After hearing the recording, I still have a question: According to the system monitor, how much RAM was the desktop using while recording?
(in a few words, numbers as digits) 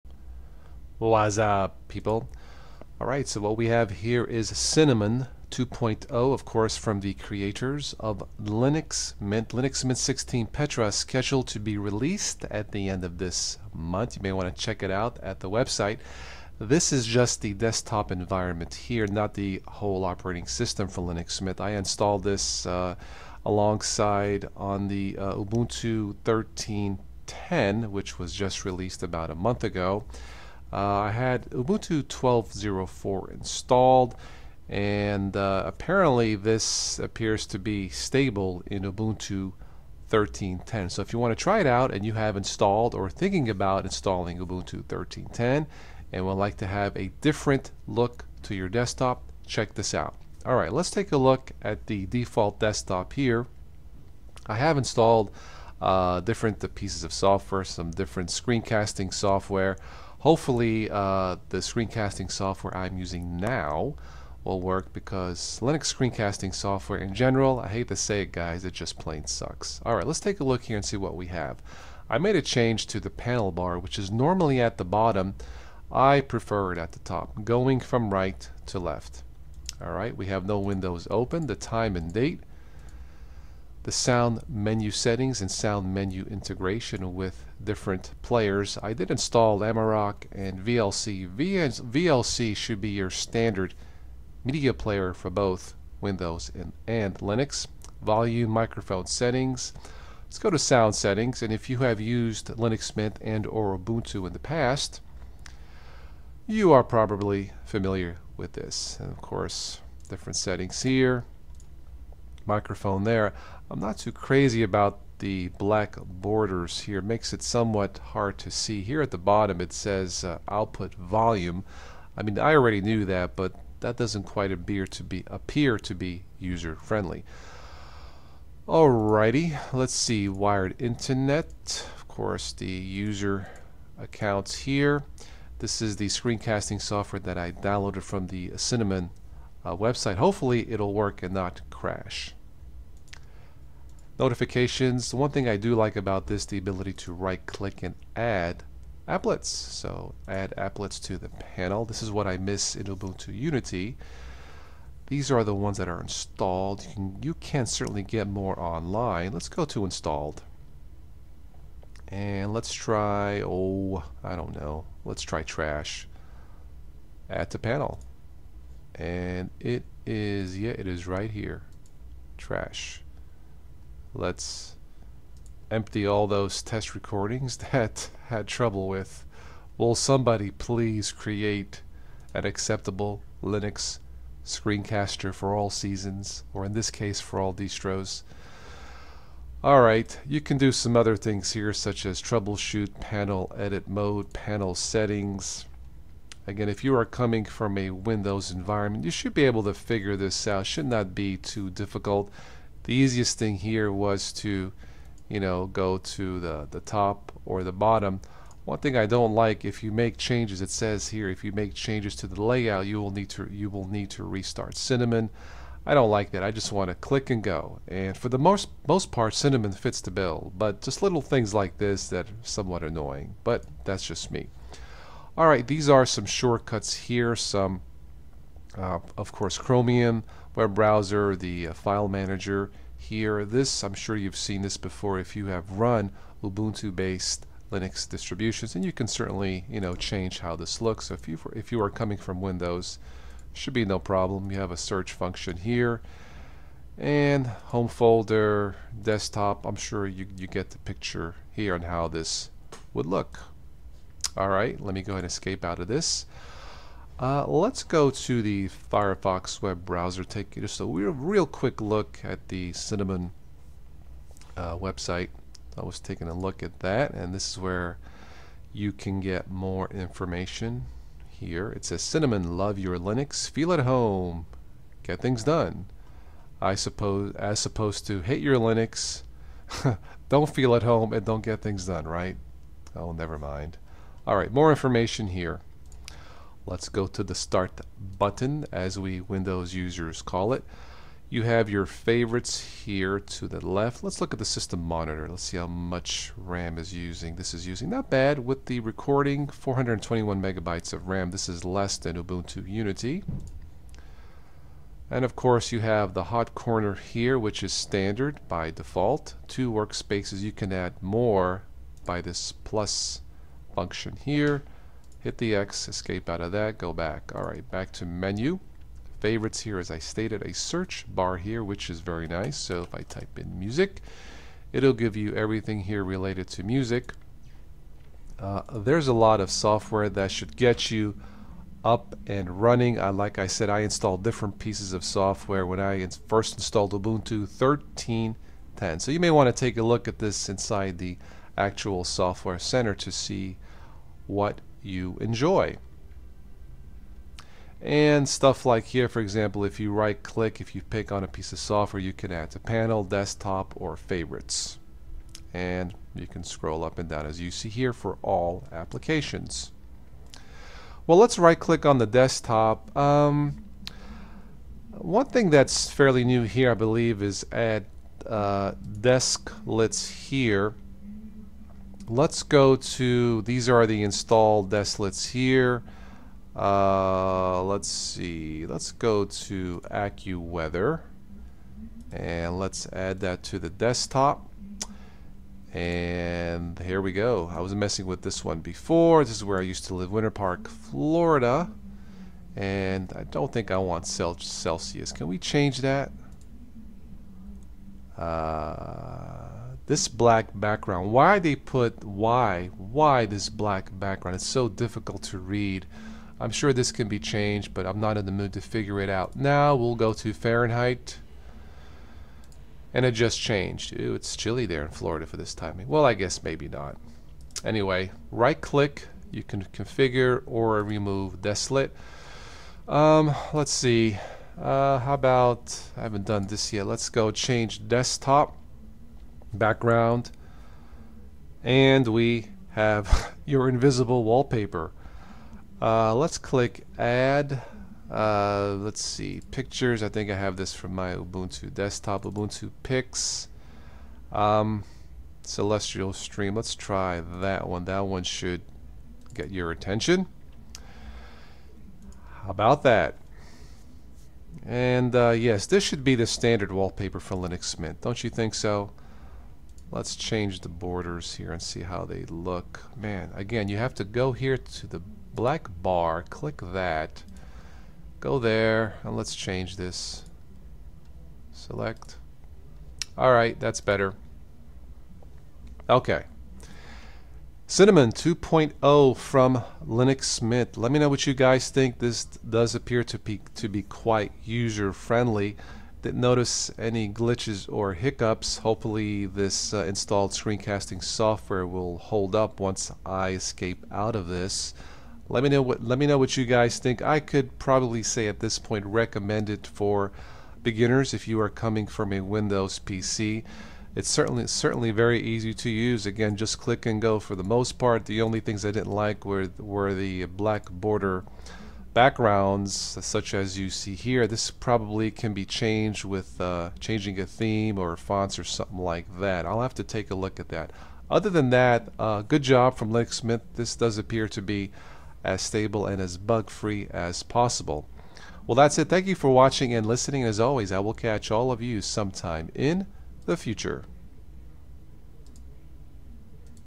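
421 megabytes.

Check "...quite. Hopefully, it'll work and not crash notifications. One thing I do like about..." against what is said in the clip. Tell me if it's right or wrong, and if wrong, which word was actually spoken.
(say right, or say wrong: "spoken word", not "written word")
wrong: "website", not "quite".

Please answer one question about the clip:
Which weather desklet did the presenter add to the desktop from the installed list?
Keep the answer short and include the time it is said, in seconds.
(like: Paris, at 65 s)
AccuWeather, at 379 s.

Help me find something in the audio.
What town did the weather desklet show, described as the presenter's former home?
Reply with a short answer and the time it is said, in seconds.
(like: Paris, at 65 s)
Winter Park, Florida, at 390 s.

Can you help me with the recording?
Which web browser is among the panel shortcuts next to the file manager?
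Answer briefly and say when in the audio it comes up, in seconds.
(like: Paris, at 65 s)
Chromium, at 229 s.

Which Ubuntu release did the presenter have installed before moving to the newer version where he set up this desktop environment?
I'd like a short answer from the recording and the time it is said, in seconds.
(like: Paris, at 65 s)
Ubuntu 12.04, at 31 s.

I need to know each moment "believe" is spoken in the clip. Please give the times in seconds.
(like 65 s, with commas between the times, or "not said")
366 s.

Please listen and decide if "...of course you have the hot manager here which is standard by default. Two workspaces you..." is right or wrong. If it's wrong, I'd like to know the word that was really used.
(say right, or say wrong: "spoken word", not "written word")
wrong: "corner", not "manager".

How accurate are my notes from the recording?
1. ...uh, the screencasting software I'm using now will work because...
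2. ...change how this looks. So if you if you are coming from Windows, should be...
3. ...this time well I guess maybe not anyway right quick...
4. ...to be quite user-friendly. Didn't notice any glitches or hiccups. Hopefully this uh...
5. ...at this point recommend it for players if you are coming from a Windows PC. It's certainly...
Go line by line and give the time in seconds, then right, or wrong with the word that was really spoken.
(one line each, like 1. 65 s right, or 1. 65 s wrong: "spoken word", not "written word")
1. 60 s right
2. 239 s right
3. 415 s wrong: "click", not "quick"
4. 483 s right
5. 498 s wrong: "beginners", not "players".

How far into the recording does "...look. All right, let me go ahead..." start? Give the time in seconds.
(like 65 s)
253 s.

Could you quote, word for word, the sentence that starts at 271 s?
It says Cinnamon, love your Linux, feel at home, get things done.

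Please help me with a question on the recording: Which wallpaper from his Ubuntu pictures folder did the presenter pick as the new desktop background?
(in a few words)
Celestial Stream.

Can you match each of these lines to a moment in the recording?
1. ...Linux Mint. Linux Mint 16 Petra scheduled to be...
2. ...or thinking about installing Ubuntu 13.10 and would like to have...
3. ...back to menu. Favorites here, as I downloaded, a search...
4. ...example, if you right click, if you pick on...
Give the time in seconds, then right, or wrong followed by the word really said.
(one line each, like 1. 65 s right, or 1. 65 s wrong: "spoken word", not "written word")
1. 8 s right
2. 42 s right
3. 317 s wrong: "stated", not "downloaded"
4. 349 s right.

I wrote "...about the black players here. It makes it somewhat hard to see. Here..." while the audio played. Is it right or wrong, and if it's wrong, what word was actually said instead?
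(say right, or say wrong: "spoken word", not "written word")
wrong: "borders", not "players".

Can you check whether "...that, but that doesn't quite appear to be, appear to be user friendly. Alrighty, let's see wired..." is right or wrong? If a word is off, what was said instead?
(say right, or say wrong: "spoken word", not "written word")
right.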